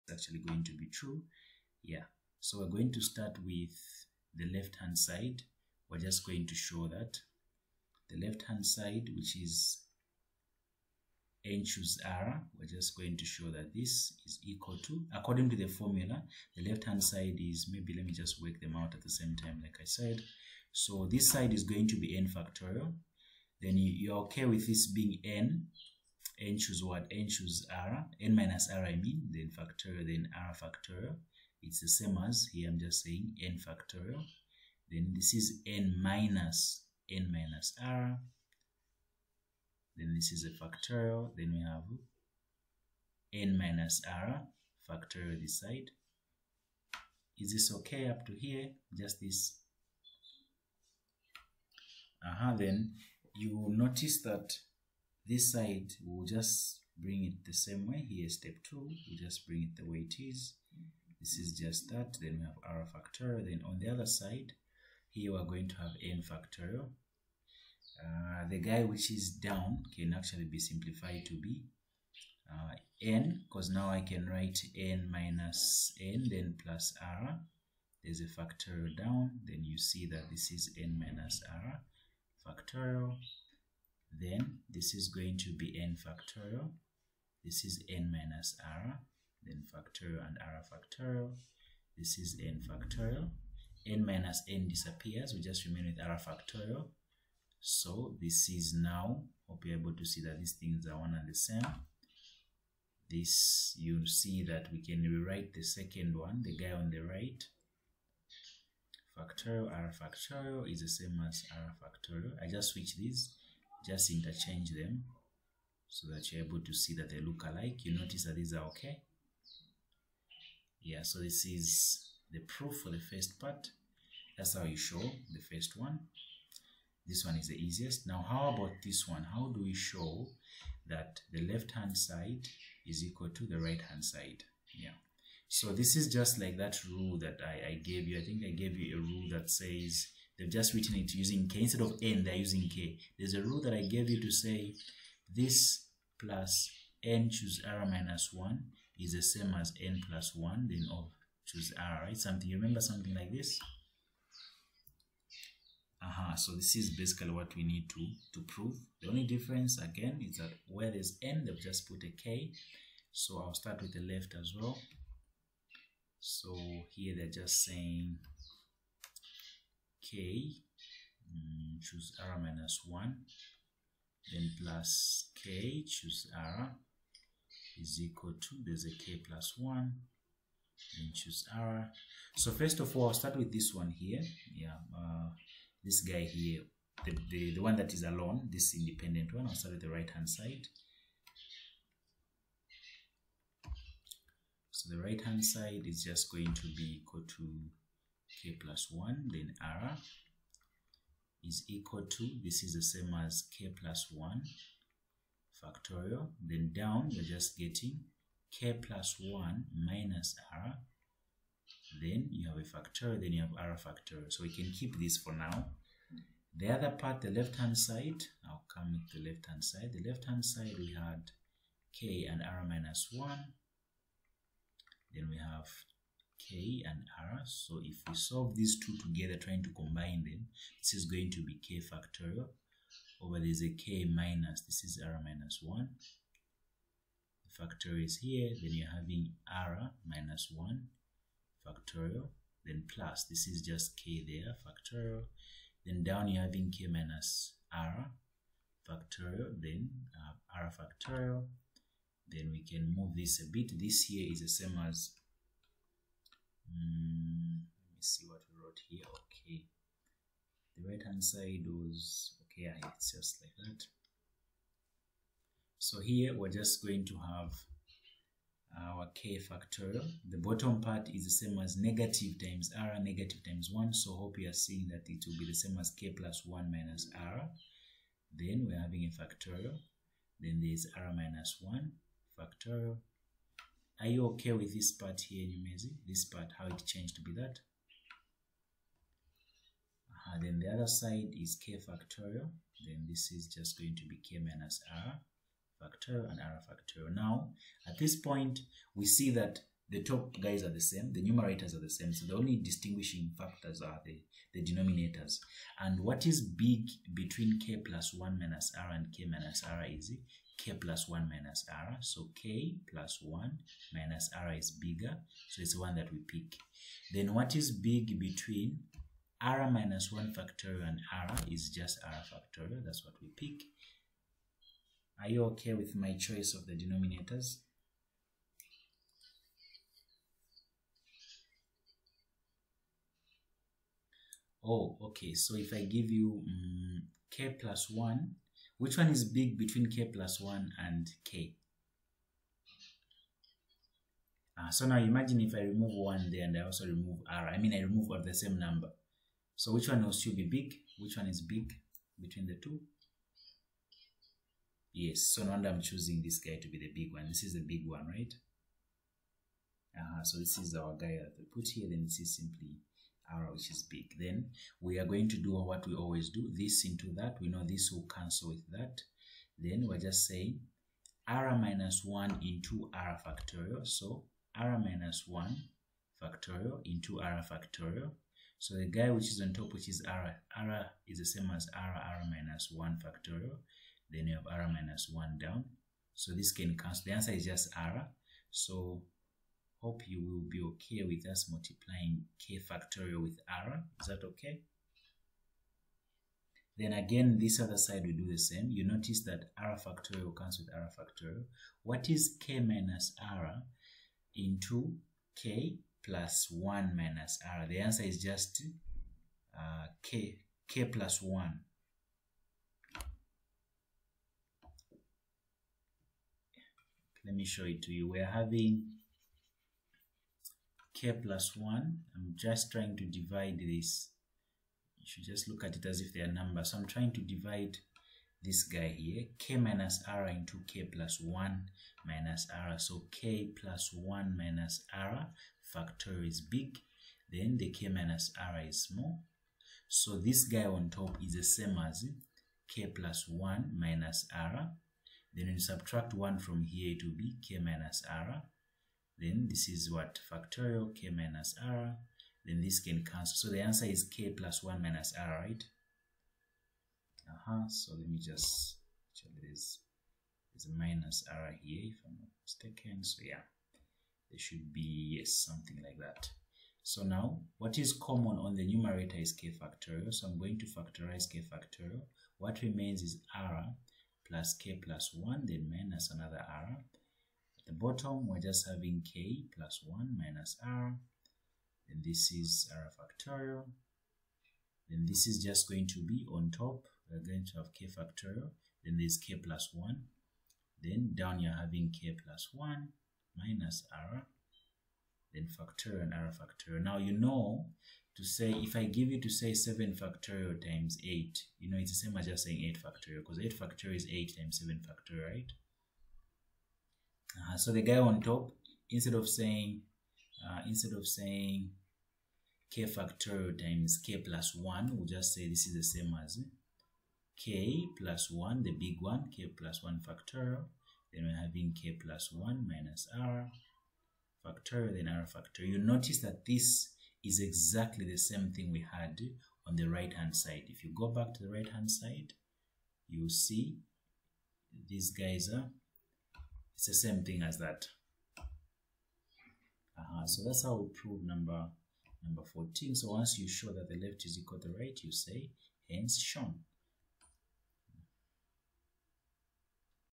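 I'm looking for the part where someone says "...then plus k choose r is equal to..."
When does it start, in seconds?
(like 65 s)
174 s.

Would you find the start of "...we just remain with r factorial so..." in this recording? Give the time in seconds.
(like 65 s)
95 s.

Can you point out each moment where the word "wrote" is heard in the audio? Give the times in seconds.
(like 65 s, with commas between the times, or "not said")
258 s.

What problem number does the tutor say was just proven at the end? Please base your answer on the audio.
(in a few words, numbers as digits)
14.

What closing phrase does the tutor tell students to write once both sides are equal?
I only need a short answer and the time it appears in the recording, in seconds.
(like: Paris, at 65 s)
hence shown, at 545 s.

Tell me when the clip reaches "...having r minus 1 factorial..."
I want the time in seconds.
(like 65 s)
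238 s.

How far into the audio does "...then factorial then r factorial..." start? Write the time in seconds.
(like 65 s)
29 s.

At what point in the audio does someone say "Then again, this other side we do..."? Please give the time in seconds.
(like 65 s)
396 s.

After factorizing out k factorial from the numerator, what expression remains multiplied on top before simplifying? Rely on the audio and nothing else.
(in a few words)
k plus 1.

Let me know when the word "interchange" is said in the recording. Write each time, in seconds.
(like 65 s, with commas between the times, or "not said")
114 s.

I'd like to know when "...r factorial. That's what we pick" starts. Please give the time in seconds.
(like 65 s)
322 s.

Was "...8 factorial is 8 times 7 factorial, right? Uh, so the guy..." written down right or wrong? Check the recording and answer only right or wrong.
right.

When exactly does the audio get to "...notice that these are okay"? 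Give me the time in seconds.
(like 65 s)
117 s.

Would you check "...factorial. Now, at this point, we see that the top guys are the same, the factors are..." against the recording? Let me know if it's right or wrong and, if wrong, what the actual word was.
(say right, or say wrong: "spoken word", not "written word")
wrong: "numerators", not "factors".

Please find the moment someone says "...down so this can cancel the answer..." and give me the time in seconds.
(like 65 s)
385 s.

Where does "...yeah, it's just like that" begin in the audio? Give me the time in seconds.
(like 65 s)
262 s.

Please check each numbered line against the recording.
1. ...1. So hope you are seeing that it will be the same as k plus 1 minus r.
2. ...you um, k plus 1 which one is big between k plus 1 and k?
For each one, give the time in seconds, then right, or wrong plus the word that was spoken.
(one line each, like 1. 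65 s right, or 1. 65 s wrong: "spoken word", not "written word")
1. 273 s right
2. 336 s right.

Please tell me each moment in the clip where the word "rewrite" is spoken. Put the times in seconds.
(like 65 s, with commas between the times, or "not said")
105 s.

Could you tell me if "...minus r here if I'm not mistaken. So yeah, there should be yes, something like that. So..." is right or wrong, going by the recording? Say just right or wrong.
right.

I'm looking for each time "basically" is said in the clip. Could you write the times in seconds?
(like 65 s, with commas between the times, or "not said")
156 s.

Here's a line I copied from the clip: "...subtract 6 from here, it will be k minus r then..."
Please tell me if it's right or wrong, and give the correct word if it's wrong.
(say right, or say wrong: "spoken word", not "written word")
wrong: "1", not "6".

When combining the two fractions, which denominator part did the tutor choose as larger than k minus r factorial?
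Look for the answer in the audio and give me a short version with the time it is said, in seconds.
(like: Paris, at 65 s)
k plus 1 minus r, at 312 s.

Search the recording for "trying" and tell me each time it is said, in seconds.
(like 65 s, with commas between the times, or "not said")
229 s, 422 s, 426 s.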